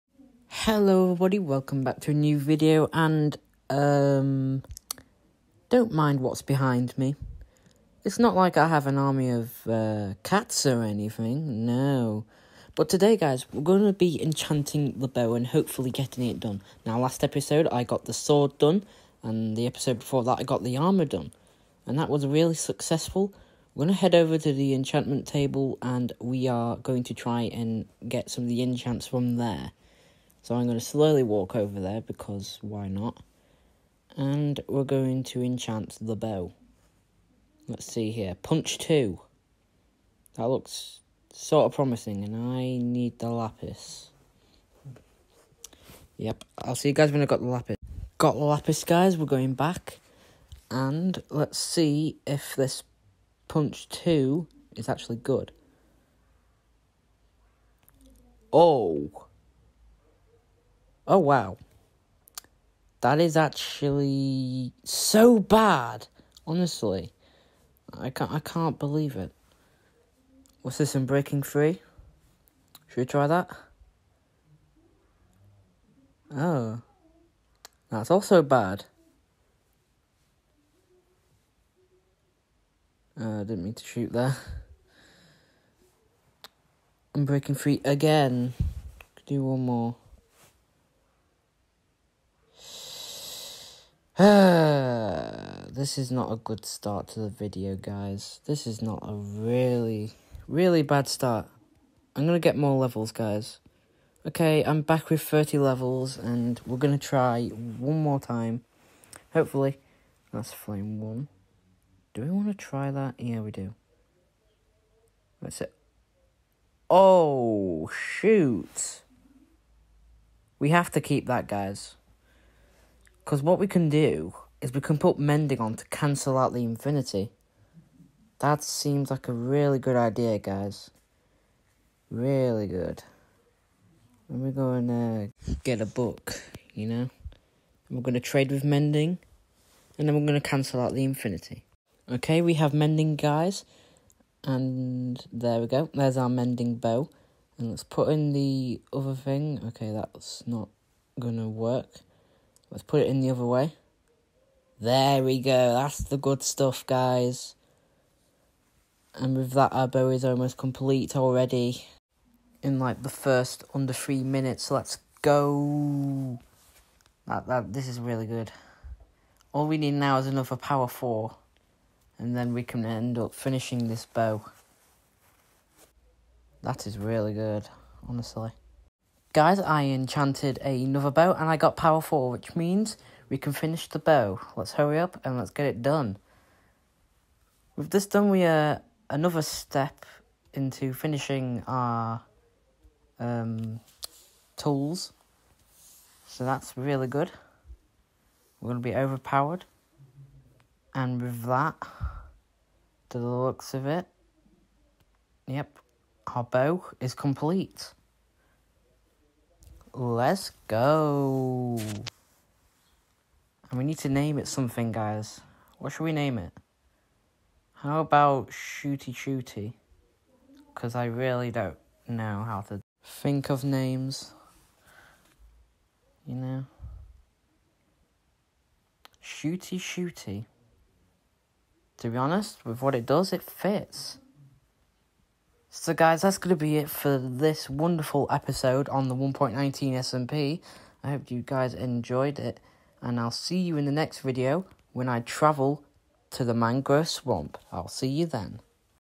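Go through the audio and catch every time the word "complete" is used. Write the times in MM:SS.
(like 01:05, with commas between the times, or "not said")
02:40, 03:27.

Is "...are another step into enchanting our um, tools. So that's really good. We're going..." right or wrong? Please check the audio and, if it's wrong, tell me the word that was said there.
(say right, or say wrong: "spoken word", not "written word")
wrong: "finishing", not "enchanting".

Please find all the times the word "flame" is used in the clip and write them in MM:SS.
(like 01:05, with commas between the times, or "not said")
01:50.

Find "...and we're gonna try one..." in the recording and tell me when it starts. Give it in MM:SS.
01:46.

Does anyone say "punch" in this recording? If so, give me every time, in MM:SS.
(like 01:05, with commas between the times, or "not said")
00:38, 00:53.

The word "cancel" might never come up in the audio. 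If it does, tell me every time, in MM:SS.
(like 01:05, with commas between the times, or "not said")
02:05, 02:20.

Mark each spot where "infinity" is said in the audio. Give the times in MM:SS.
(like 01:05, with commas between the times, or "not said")
02:06, 02:21.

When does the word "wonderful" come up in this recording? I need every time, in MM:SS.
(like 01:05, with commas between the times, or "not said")
03:57.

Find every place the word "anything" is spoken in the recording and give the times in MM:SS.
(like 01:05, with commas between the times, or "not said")
00:10.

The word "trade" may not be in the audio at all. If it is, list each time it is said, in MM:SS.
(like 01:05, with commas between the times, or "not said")
02:18.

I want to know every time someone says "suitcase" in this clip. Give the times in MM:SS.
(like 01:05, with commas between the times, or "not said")
not said.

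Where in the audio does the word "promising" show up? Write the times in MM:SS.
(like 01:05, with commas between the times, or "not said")
00:41.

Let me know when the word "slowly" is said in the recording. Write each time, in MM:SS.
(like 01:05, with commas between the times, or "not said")
00:30.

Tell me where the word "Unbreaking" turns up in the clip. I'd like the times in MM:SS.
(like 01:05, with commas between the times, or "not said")
01:10, 01:27.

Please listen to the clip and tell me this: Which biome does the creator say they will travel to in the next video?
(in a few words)
Mangrove swamp.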